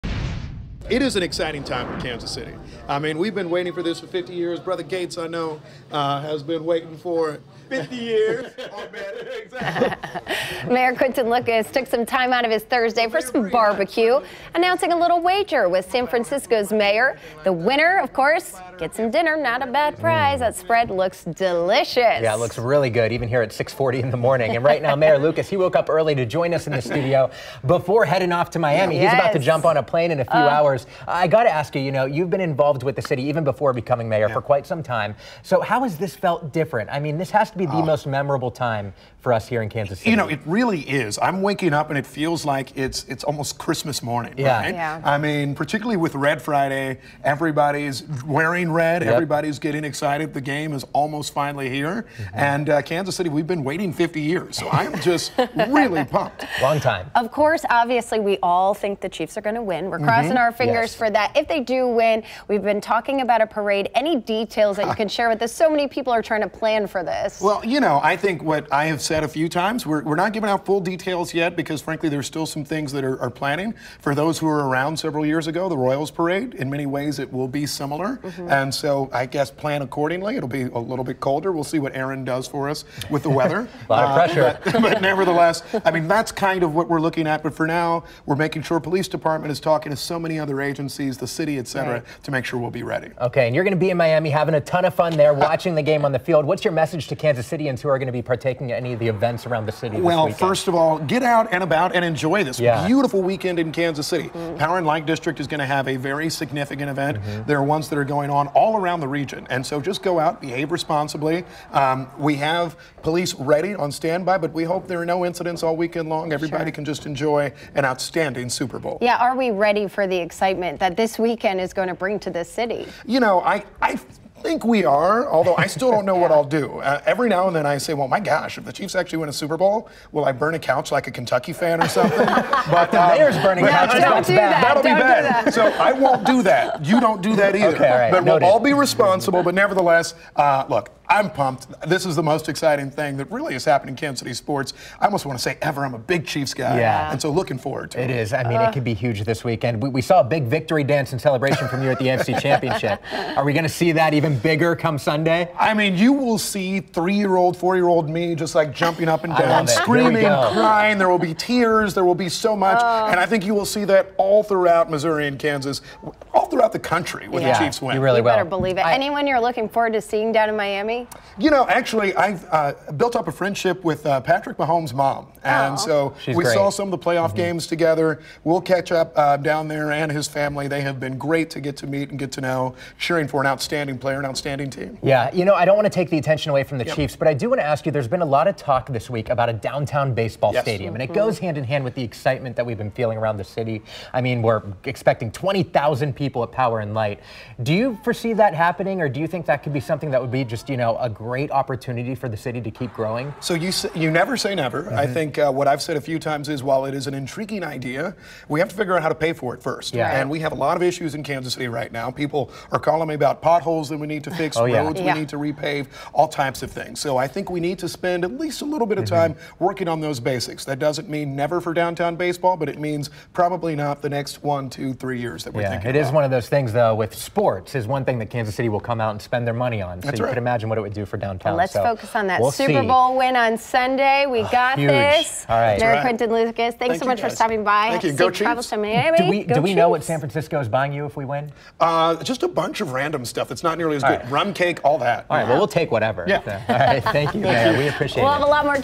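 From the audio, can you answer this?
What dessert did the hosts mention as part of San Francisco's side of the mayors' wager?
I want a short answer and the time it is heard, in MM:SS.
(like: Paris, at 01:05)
Rum cake, at 04:04.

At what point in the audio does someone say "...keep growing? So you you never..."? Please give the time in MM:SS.
03:22.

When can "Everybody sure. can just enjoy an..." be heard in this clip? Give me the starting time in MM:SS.
01:56.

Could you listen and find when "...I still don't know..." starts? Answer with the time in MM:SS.
02:05.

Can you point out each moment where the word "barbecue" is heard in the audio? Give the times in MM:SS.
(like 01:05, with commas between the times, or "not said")
00:13.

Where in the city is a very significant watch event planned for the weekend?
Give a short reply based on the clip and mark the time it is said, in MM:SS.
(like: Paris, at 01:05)
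Power and Light District, at 01:44.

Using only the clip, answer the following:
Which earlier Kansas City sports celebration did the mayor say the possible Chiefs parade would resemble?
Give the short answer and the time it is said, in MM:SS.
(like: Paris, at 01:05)
Royals Parade, at 01:15.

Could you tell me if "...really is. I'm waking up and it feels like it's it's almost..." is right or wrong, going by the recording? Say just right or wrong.
right.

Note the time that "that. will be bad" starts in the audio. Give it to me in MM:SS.
02:14.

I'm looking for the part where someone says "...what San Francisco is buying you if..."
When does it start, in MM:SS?
03:59.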